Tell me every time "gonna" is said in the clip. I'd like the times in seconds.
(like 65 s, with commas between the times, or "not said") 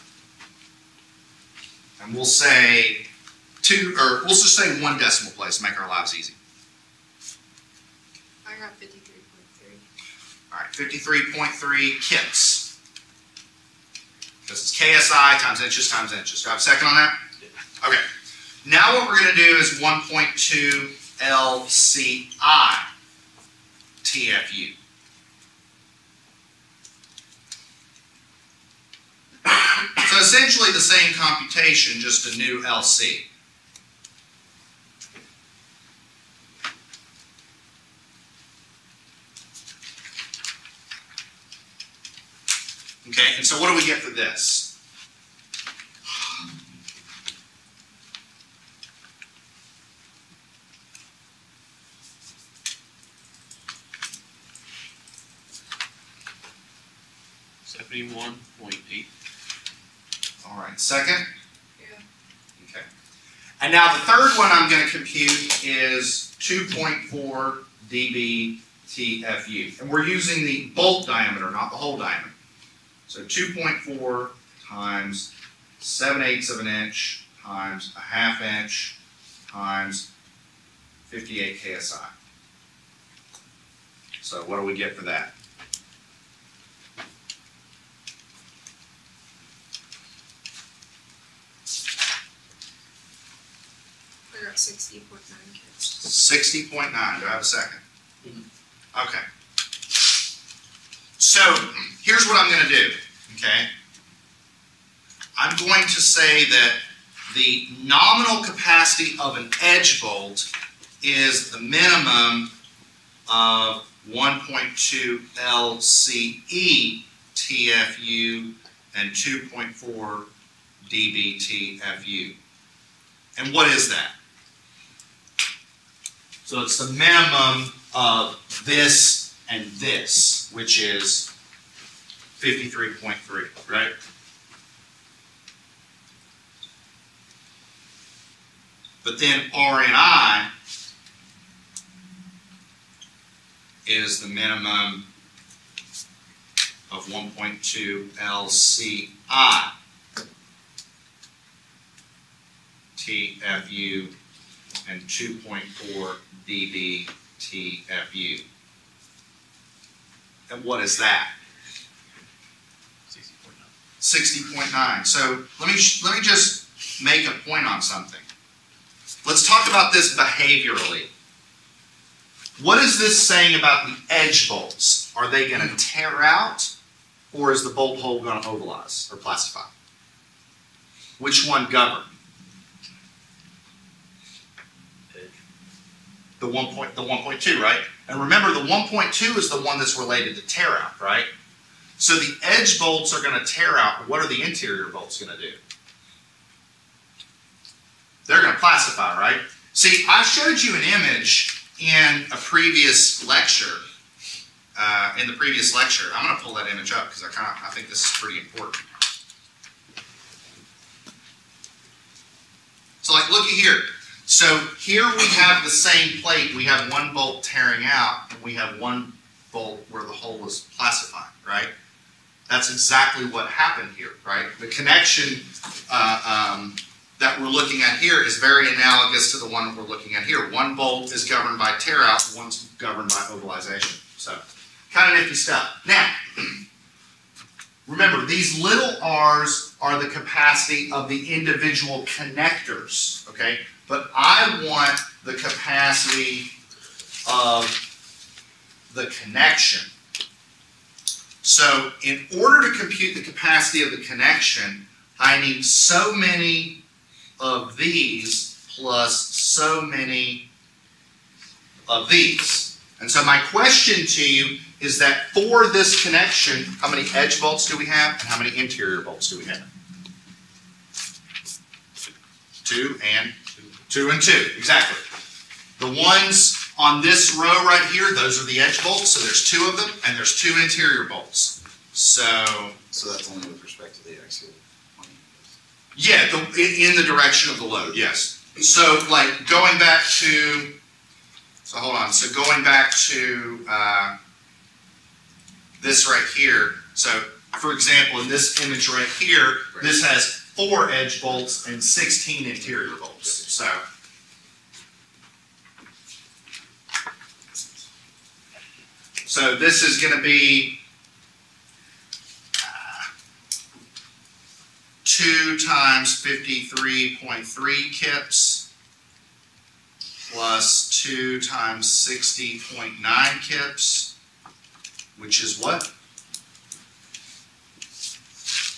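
102 s.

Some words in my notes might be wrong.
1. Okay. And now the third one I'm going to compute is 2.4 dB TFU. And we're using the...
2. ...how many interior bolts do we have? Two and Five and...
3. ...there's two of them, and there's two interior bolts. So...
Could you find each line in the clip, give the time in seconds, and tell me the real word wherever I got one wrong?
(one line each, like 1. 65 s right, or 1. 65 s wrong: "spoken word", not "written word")
1. 62 s right
2. 268 s wrong: "Two", not "Five"
3. 279 s right.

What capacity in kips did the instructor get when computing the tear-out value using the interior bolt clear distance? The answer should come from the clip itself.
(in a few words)
71.8 kips.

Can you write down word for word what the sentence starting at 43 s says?
Okay, and so what do we get for this?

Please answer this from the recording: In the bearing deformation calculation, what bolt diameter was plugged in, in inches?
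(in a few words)
7/8 inch.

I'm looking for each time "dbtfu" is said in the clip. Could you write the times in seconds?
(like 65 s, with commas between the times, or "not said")
120 s, 156 s.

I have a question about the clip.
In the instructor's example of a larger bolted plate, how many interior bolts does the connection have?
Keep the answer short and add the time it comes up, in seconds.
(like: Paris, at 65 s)
16, at 301 s.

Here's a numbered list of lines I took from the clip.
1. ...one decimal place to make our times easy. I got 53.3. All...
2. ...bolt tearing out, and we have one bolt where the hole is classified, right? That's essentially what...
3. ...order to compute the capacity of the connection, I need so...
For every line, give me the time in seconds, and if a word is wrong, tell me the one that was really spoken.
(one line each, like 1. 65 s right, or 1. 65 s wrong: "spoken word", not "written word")
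1. 4 s wrong: "lives", not "times"
2. 217 s wrong: "exactly", not "essentially"
3. 252 s right.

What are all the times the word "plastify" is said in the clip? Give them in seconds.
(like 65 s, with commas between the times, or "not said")
179 s, 198 s.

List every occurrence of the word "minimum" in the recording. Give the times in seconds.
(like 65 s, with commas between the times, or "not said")
111 s, 126 s, 144 s.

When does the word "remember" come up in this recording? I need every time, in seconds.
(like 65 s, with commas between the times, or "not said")
188 s, 237 s.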